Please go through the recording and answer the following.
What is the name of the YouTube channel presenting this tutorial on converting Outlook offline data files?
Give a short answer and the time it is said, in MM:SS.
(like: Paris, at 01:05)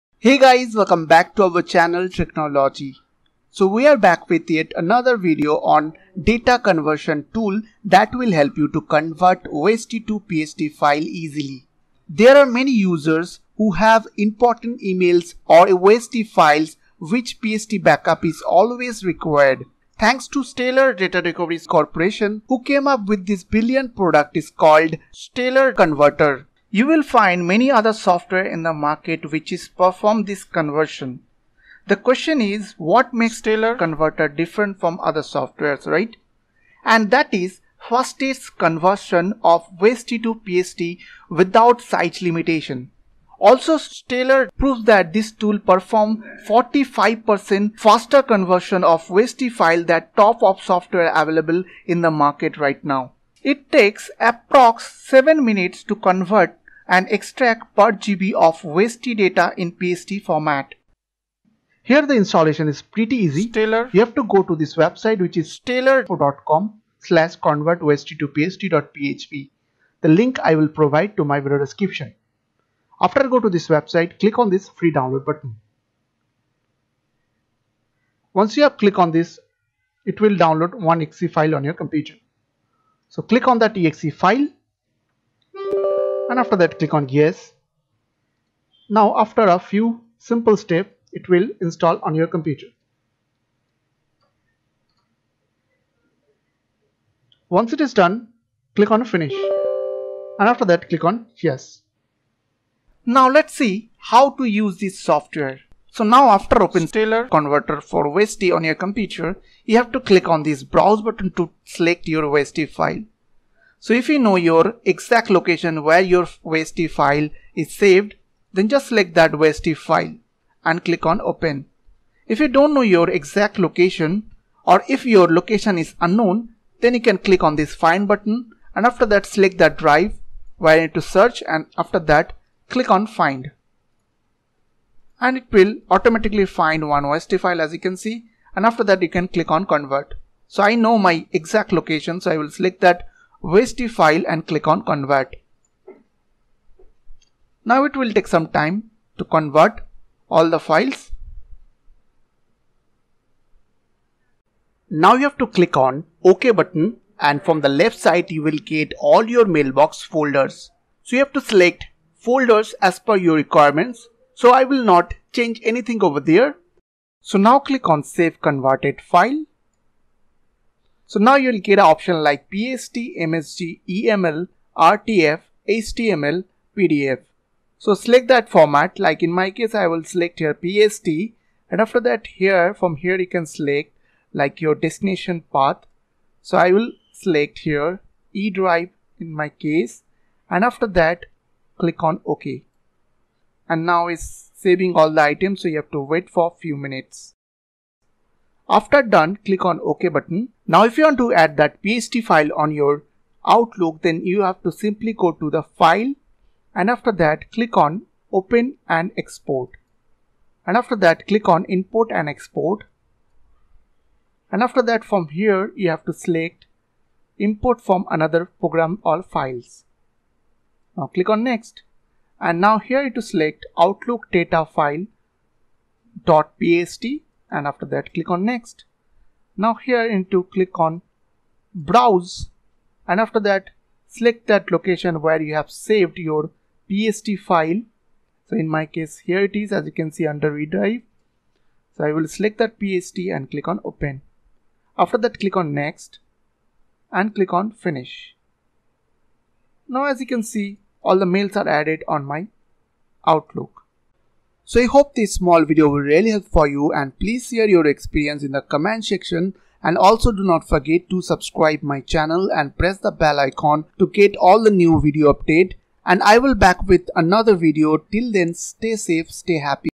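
Tricknology, at 00:02.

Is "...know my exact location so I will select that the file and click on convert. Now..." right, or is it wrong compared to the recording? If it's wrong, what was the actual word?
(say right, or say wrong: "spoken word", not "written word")
right.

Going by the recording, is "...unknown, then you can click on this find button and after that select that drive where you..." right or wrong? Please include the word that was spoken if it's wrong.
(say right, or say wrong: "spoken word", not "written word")
right.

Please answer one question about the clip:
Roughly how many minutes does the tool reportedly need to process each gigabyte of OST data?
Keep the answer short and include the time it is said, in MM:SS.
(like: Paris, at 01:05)
7 minutes, at 00:55.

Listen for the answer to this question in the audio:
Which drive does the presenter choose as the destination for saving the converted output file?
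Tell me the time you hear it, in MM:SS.
03:08.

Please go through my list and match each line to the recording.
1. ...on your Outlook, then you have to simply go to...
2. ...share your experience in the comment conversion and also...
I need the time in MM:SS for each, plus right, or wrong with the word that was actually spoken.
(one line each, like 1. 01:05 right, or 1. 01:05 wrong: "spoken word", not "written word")
1. 03:22 right
2. 04:17 wrong: "section", not "conversion".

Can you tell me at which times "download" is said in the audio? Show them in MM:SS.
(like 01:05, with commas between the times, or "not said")
01:14, 01:20.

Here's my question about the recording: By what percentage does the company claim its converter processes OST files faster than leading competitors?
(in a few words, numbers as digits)
45%.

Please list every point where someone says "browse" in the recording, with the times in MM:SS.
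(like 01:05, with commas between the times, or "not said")
01:50, 03:51.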